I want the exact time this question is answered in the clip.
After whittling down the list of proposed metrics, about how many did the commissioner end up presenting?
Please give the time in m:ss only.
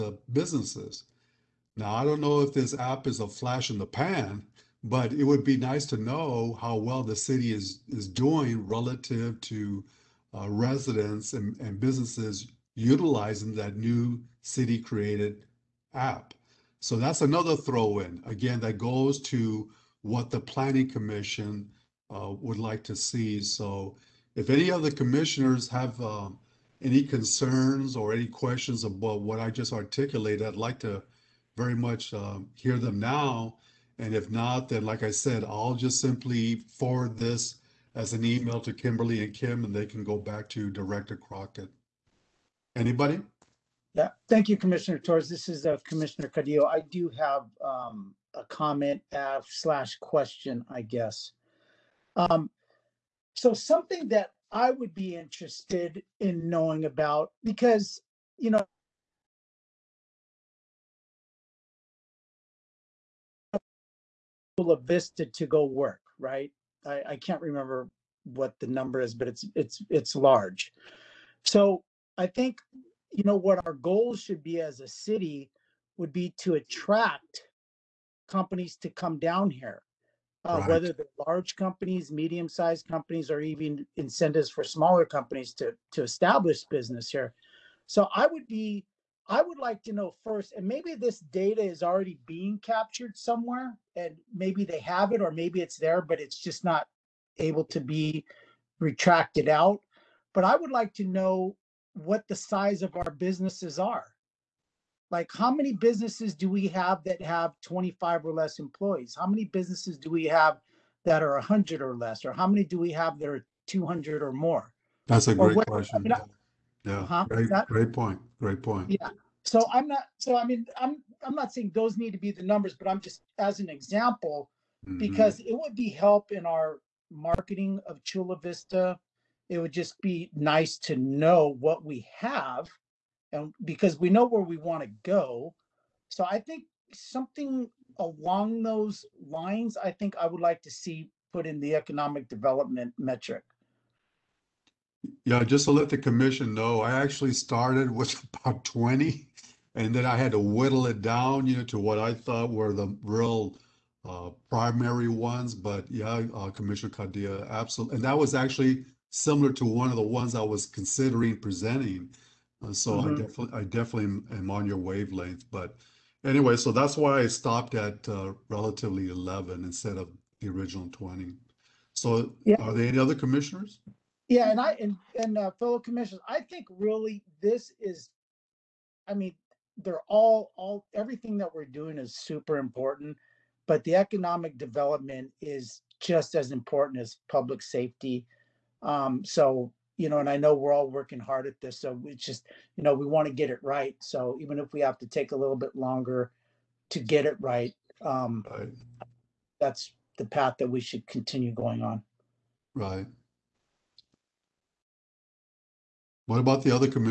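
2:48.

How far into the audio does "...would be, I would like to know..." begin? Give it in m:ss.
1:28.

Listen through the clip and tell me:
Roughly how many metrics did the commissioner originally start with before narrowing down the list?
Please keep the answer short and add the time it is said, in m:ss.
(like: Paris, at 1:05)
20, at 2:28.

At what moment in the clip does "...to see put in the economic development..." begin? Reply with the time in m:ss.
2:20.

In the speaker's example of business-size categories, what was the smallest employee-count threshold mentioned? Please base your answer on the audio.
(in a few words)
25 or less.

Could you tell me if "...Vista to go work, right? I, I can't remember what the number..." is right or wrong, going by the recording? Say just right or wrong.
right.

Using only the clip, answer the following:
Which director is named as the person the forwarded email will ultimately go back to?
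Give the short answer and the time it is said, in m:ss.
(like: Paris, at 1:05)
Director Crockett, at 0:40.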